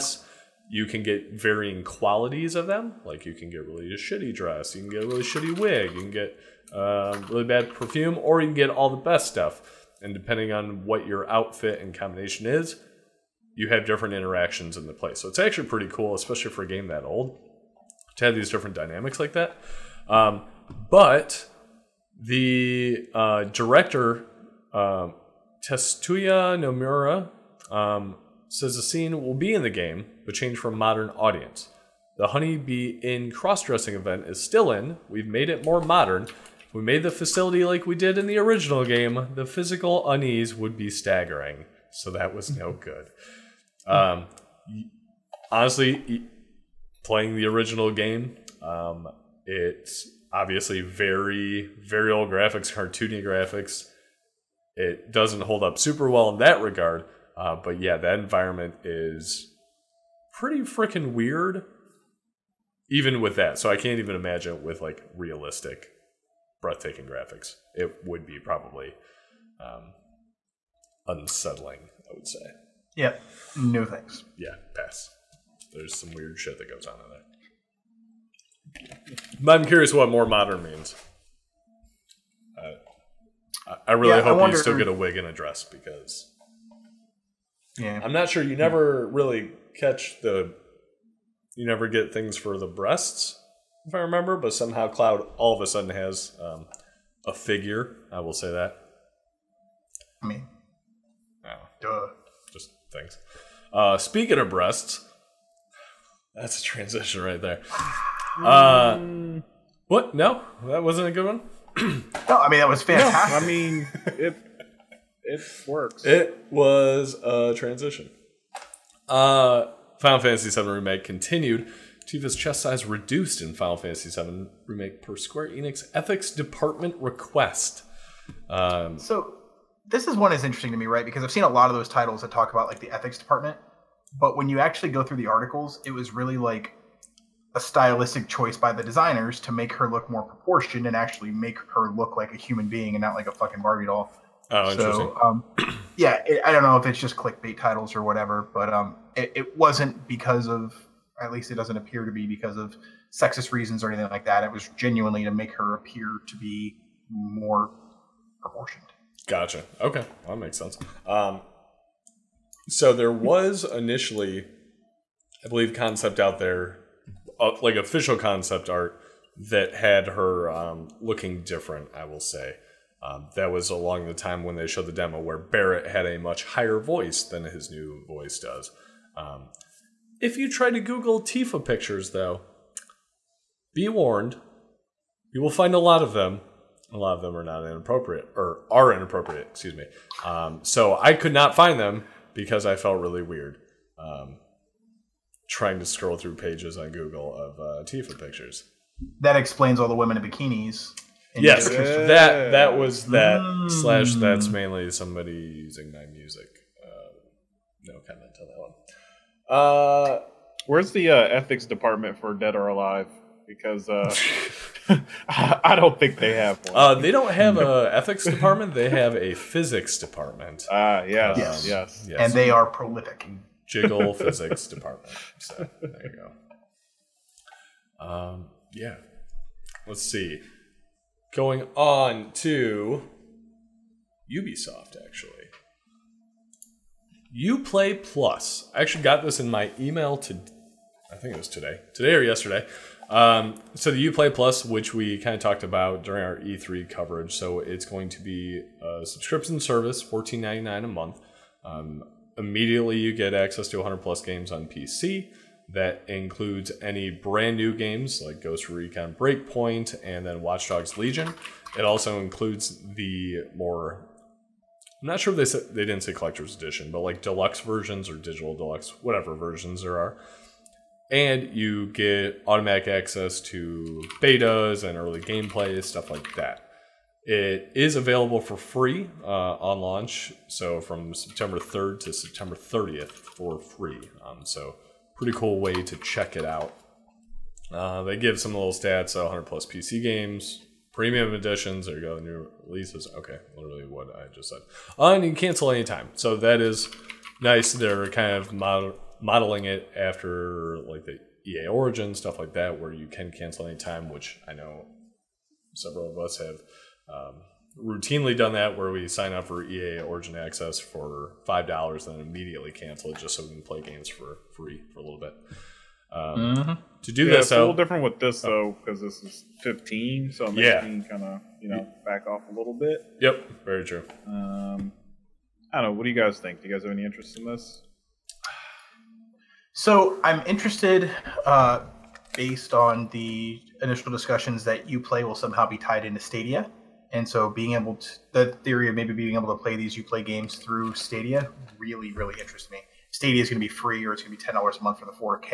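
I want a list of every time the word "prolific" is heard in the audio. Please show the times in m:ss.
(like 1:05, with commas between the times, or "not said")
3:42.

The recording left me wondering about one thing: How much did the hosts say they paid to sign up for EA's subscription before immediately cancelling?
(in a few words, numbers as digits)
5 dollars.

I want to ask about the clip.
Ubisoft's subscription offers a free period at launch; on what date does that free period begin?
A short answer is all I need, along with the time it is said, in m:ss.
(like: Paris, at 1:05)
September 3rd, at 4:41.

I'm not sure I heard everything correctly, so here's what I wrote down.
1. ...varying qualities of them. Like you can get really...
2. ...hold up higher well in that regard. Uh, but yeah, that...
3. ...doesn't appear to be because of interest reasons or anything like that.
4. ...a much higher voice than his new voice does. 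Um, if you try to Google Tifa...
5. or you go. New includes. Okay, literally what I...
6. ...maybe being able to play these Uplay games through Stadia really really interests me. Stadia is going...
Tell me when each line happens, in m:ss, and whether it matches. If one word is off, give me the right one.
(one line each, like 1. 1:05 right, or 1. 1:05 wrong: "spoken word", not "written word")
1. 0:01 right
2. 0:55 wrong: "super", not "higher"
3. 2:31 wrong: "sexist", not "interest"
4. 2:56 right
5. 4:51 wrong: "releases", not "includes"
6. 5:38 right.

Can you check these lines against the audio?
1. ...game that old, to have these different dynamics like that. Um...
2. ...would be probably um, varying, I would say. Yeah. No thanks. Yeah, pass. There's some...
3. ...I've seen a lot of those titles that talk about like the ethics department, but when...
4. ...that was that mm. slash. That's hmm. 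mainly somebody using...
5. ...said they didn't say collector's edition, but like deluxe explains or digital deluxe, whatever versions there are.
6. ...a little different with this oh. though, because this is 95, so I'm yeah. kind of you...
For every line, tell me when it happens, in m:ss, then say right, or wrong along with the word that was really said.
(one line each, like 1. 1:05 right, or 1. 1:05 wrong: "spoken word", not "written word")
1. 0:16 right
2. 1:08 wrong: "unsettling", not "varying"
3. 2:11 right
4. 3:22 right
5. 4:25 wrong: "versions", not "explains"
6. 5:17 wrong: "15", not "95".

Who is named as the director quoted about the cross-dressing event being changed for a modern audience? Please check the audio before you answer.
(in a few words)
Tetsuya Nomura.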